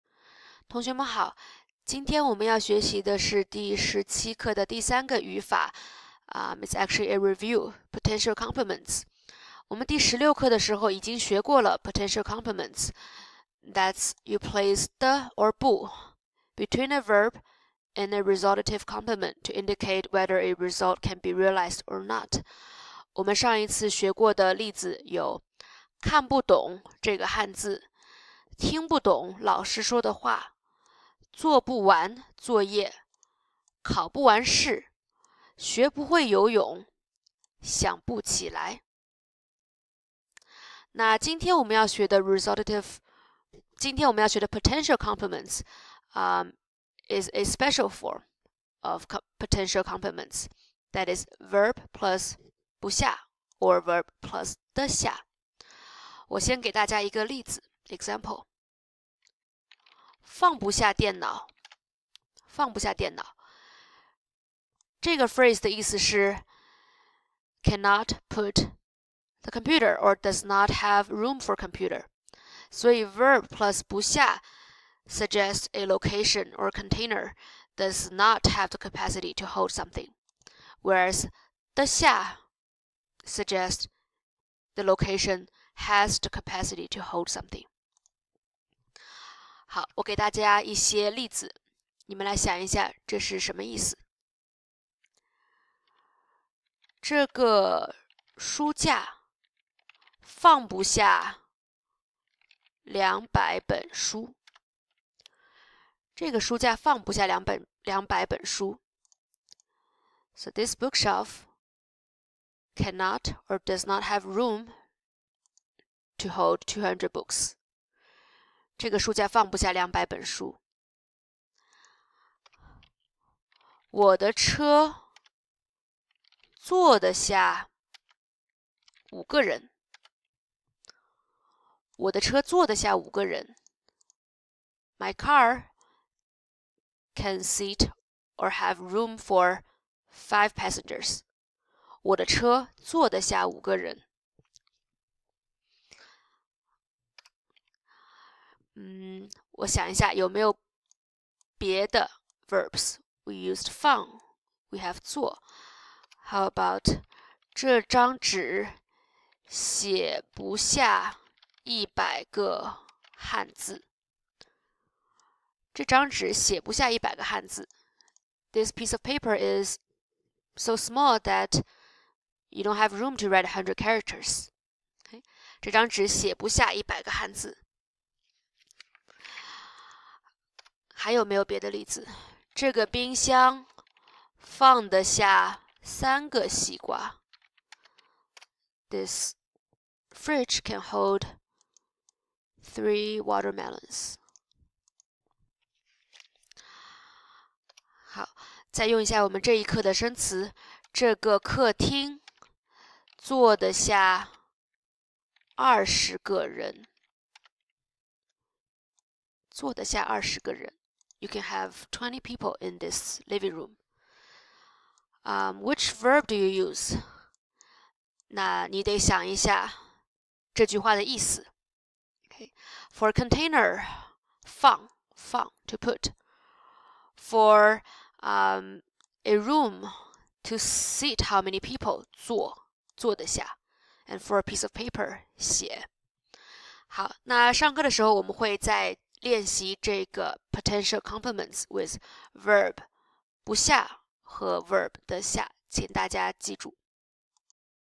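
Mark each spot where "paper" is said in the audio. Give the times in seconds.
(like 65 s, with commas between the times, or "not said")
169 s, 234 s.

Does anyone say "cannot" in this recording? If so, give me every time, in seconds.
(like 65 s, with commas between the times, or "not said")
67 s, 112 s.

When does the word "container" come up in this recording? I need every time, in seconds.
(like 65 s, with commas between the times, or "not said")
76 s, 223 s.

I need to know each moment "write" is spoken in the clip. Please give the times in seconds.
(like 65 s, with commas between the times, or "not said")
173 s.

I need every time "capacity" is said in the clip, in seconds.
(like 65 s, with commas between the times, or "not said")
78 s, 86 s.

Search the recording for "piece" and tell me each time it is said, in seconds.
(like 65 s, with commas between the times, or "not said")
157 s, 234 s.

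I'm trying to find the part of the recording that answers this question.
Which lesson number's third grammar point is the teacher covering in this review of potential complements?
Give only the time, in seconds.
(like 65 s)
3 s.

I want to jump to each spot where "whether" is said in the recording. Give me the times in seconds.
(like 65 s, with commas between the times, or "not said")
20 s.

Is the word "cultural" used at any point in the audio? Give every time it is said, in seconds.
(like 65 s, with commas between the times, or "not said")
not said.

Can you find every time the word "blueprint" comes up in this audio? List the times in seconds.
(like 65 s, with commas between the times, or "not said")
not said.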